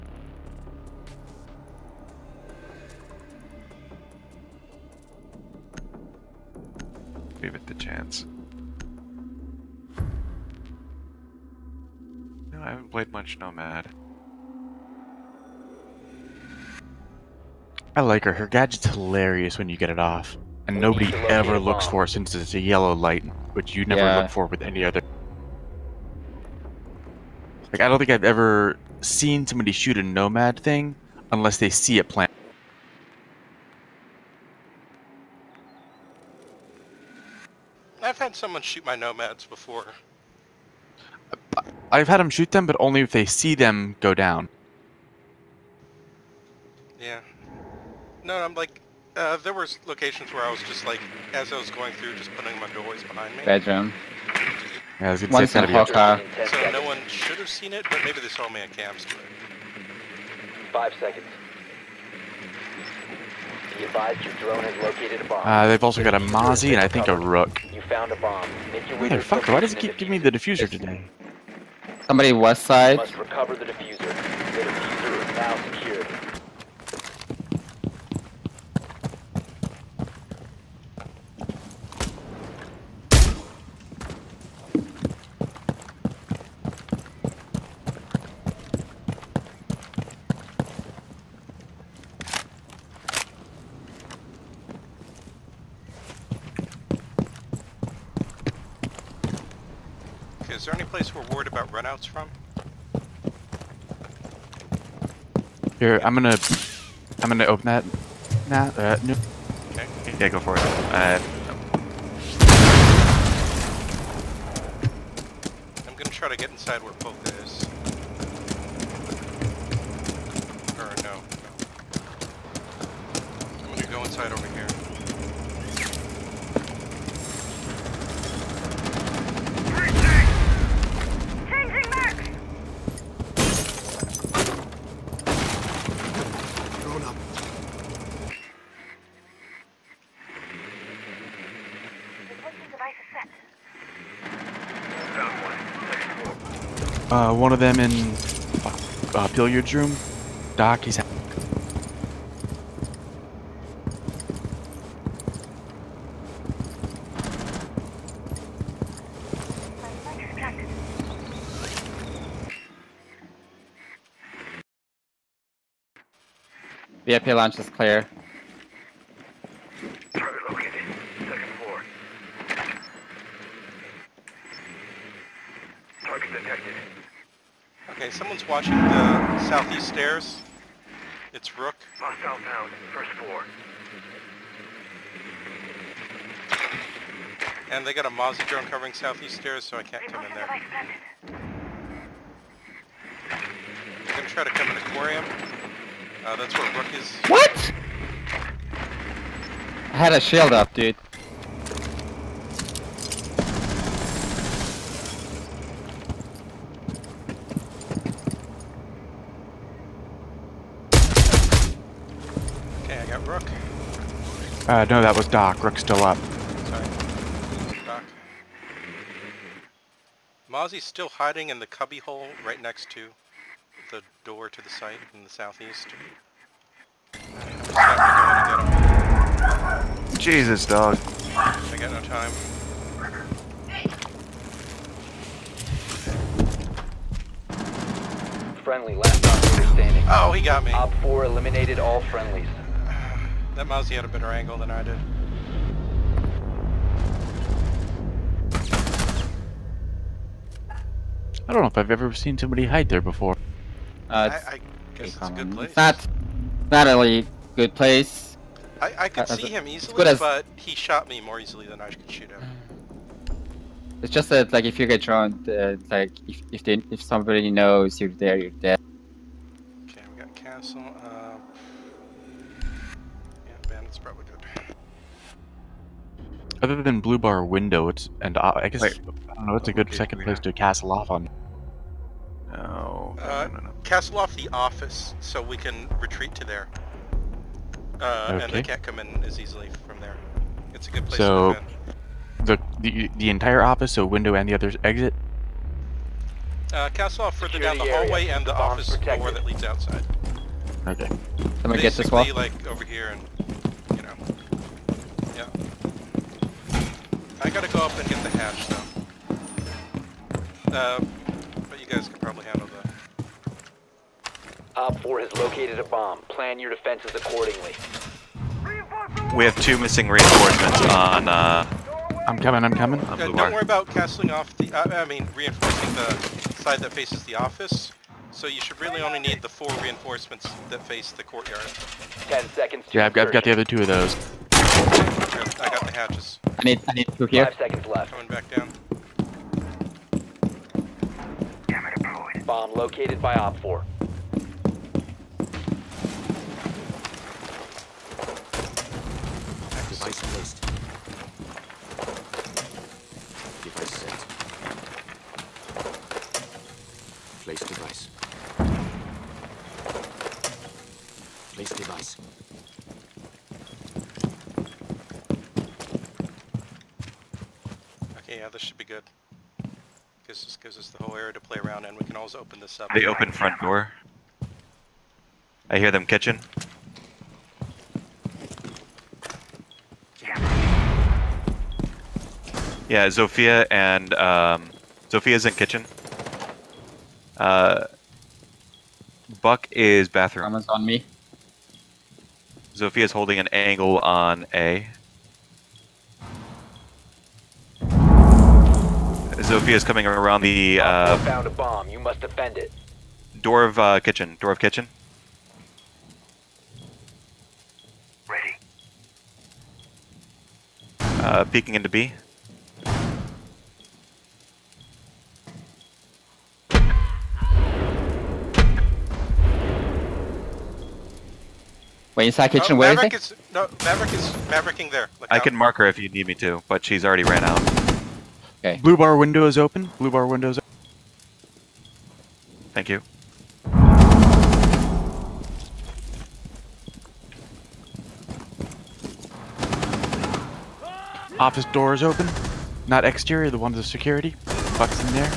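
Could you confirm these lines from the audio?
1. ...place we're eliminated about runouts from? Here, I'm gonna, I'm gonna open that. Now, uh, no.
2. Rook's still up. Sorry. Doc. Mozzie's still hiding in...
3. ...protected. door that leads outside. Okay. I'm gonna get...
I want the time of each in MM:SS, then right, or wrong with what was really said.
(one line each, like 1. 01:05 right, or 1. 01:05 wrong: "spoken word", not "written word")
1. 01:40 wrong: "worried", not "eliminated"
2. 03:35 right
3. 04:58 right.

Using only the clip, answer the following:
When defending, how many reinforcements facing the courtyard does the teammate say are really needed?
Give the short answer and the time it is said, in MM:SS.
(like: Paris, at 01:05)
4, at 05:29.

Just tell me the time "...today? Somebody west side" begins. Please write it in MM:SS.
01:10.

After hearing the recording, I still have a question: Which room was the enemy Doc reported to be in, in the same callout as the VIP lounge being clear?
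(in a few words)
Billiards room.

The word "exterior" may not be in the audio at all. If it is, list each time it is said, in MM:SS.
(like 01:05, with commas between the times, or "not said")
07:23.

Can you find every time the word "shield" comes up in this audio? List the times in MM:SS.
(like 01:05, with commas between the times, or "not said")
03:20.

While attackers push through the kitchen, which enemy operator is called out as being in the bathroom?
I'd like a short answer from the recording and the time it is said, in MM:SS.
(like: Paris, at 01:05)
Buck, at 06:29.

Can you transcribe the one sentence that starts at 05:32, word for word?
Yeah, I've, I've got the other two of those.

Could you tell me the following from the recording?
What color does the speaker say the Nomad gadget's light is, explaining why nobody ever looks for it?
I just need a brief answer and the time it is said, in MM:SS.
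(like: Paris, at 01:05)
Yellow, at 00:22.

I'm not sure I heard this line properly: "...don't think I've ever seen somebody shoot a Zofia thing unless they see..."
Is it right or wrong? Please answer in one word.
wrong.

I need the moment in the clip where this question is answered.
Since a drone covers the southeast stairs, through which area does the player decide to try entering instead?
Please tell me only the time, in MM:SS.
03:14.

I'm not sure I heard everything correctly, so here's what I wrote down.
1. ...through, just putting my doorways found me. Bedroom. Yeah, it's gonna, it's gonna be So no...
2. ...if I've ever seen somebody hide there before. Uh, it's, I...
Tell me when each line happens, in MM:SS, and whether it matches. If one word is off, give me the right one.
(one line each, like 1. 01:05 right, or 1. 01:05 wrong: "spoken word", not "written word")
1. 00:51 wrong: "behind", not "found"
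2. 04:11 right.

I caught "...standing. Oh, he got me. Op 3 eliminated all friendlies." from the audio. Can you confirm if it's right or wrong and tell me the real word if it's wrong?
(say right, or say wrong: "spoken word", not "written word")
wrong: "4", not "3".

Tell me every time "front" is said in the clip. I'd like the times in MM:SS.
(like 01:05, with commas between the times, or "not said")
06:13.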